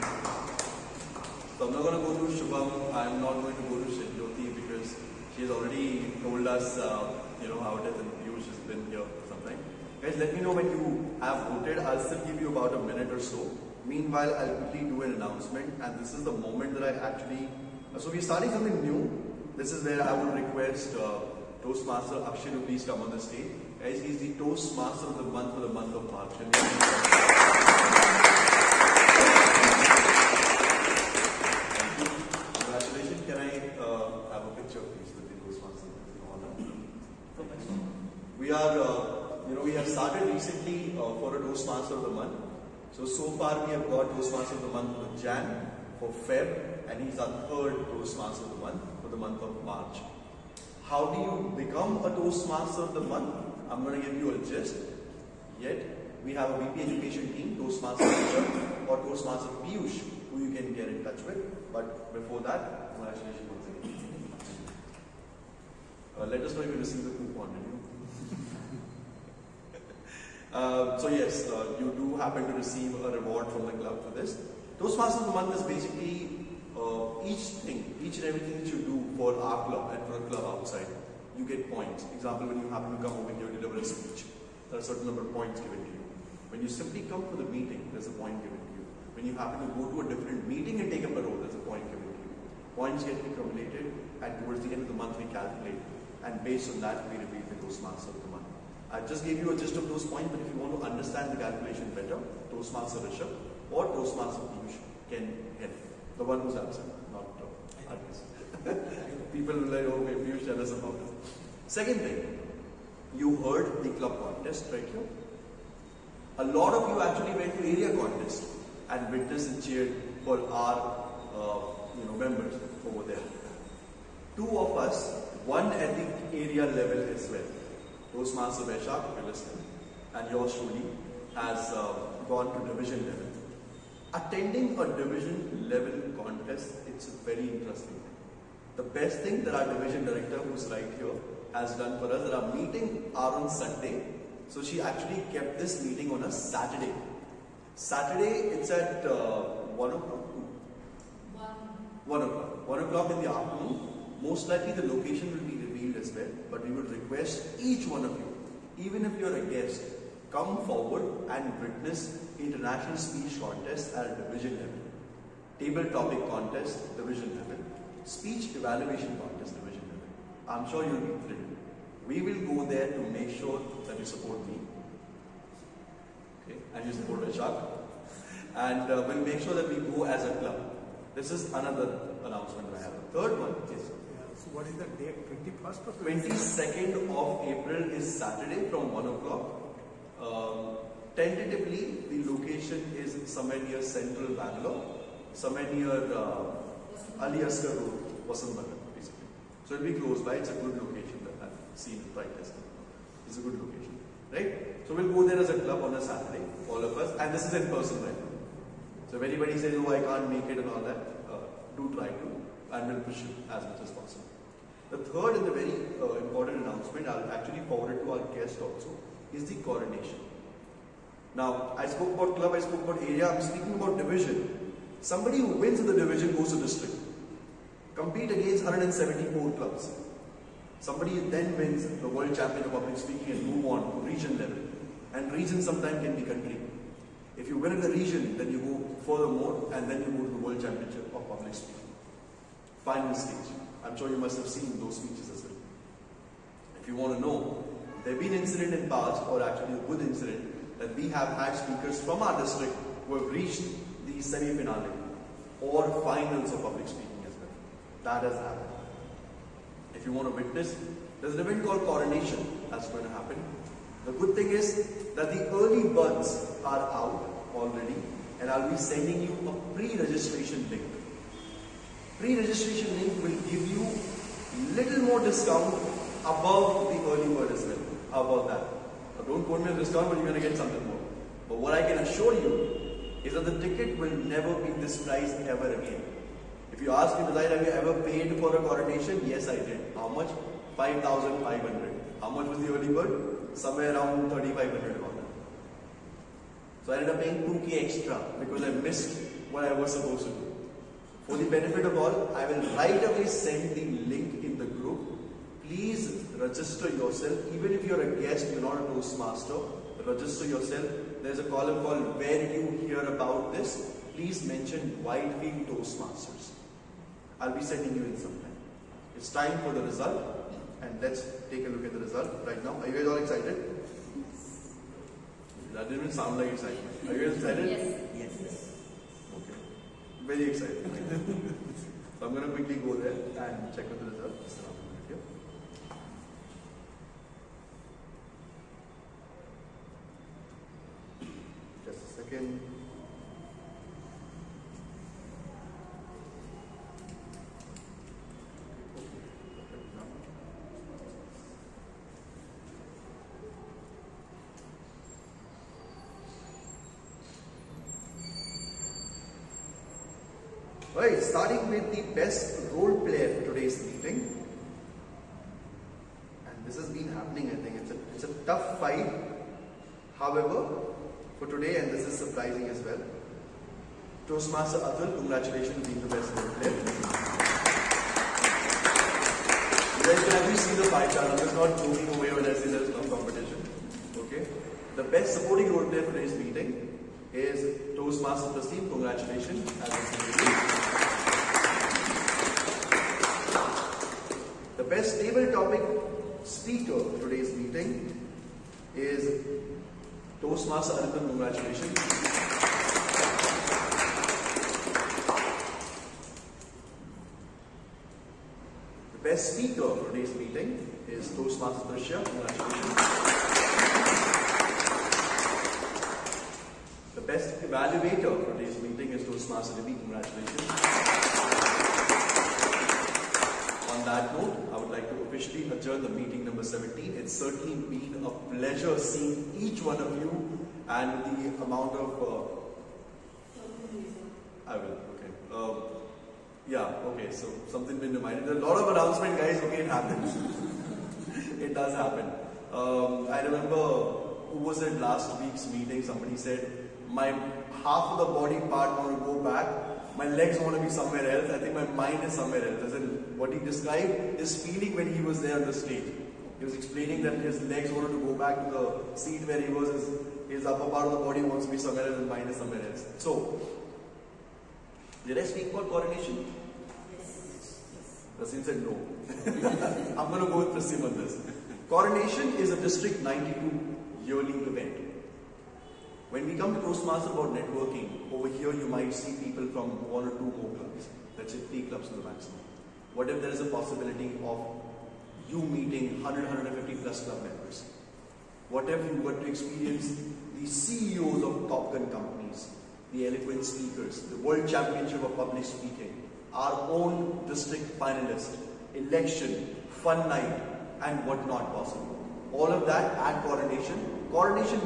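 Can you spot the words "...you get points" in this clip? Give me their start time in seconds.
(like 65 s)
81 s.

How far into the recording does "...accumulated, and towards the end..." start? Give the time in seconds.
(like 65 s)
93 s.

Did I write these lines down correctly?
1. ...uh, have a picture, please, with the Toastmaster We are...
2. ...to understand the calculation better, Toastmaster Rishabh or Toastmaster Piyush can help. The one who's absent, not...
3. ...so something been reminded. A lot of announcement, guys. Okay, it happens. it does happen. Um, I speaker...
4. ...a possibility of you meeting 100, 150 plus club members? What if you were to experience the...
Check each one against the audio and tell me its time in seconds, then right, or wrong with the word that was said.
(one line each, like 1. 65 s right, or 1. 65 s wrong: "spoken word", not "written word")
1. 33 s right
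2. 100 s right
3. 437 s wrong: "remember", not "speaker"
4. 483 s right.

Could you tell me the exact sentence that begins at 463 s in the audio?
So, did I speak about coronation?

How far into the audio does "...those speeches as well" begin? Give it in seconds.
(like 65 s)
244 s.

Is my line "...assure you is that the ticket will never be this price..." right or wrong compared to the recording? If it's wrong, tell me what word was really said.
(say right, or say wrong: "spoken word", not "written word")
right.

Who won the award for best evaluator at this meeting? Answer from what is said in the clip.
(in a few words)
Devi.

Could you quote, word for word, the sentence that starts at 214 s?
The third and the very uh, important announcement, I'll actually forward it to our guest also, is the coronation.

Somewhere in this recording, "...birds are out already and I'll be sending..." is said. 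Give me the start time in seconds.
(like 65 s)
265 s.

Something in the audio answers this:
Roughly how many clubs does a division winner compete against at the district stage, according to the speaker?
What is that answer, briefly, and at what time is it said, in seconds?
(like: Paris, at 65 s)
174, at 228 s.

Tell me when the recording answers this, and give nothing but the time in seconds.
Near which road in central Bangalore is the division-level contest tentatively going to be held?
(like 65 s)
197 s.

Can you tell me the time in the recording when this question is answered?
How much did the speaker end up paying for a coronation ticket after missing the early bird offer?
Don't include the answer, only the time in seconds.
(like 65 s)
290 s.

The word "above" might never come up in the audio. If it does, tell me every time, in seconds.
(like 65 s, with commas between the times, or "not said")
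276 s.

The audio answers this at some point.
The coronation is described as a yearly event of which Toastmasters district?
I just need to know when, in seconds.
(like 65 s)
472 s.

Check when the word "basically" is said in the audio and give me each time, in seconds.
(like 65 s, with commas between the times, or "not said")
75 s, 198 s.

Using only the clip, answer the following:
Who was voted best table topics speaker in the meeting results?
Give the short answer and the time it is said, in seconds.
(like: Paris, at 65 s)
Anupam, at 400 s.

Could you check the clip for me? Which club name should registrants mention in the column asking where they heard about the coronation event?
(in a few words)
Whitefield Toastmasters.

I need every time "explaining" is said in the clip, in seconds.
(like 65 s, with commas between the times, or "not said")
456 s.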